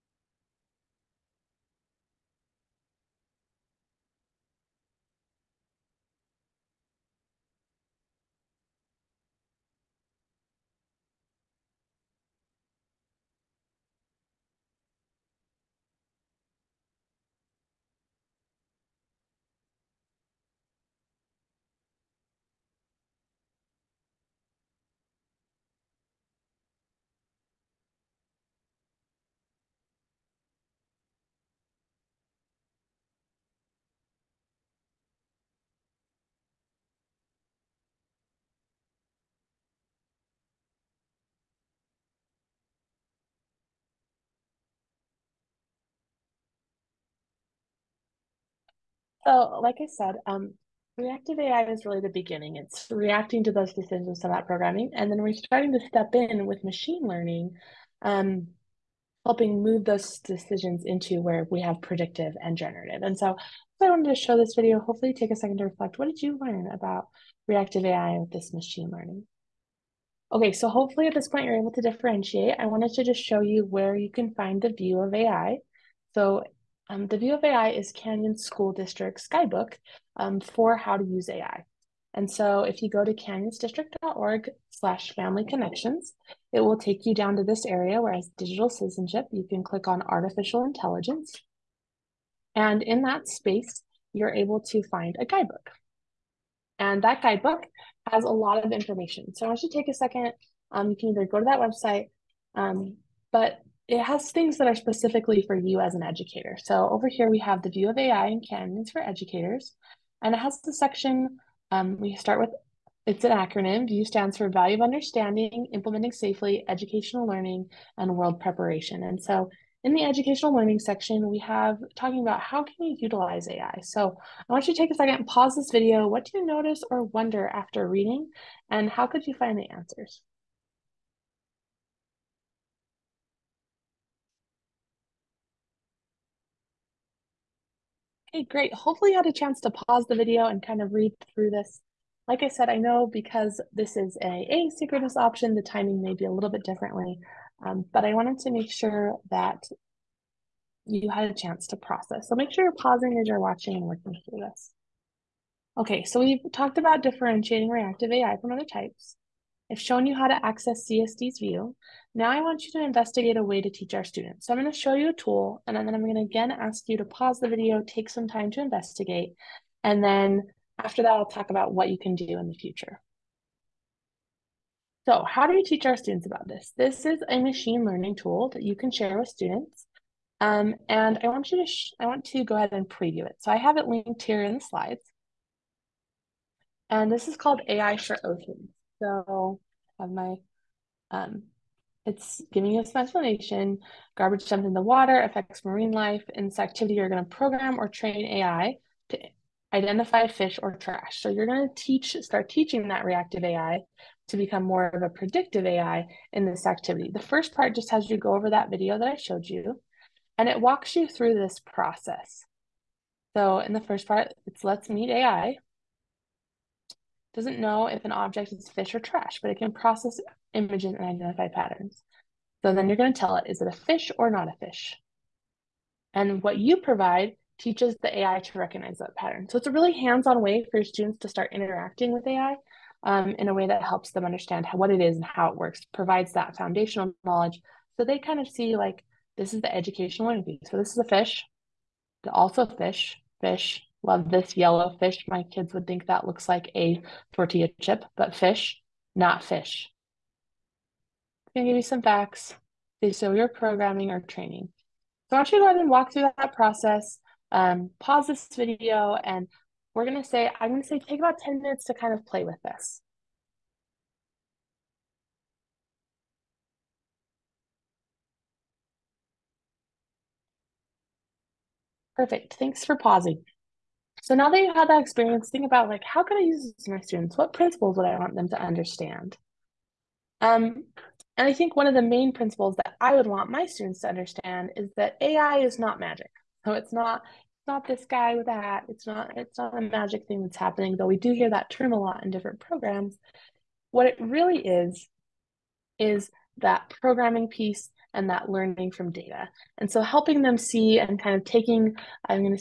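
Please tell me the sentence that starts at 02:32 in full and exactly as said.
So make sure you're pausing as you're watching and working through this.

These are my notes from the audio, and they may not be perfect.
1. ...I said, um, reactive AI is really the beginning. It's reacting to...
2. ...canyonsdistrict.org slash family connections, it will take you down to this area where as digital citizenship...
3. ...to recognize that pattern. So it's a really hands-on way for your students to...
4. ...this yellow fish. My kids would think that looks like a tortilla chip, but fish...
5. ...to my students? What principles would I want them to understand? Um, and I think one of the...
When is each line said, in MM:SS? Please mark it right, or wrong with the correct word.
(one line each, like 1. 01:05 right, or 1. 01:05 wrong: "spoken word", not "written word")
1. 00:49 right
2. 01:23 right
3. 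03:48 right
4. 04:04 right
5. 04:36 right.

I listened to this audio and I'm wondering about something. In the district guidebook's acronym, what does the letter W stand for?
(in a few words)
World Preparation.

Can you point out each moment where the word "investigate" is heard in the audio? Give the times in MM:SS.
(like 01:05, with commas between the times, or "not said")
02:42, 02:48.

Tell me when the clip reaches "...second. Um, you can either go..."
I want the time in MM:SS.
01:39.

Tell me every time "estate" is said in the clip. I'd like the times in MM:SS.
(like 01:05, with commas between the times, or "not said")
not said.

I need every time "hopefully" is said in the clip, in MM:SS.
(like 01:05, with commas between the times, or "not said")
01:04, 01:10, 02:18.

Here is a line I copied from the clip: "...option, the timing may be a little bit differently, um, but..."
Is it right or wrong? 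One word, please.
right.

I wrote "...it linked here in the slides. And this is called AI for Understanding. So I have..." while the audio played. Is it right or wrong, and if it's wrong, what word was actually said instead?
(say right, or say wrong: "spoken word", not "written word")
wrong: "Oceans", not "Understanding".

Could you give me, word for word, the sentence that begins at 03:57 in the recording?
So they kind of see like, this is the educational interview.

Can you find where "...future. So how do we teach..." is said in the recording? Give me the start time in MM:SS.
02:52.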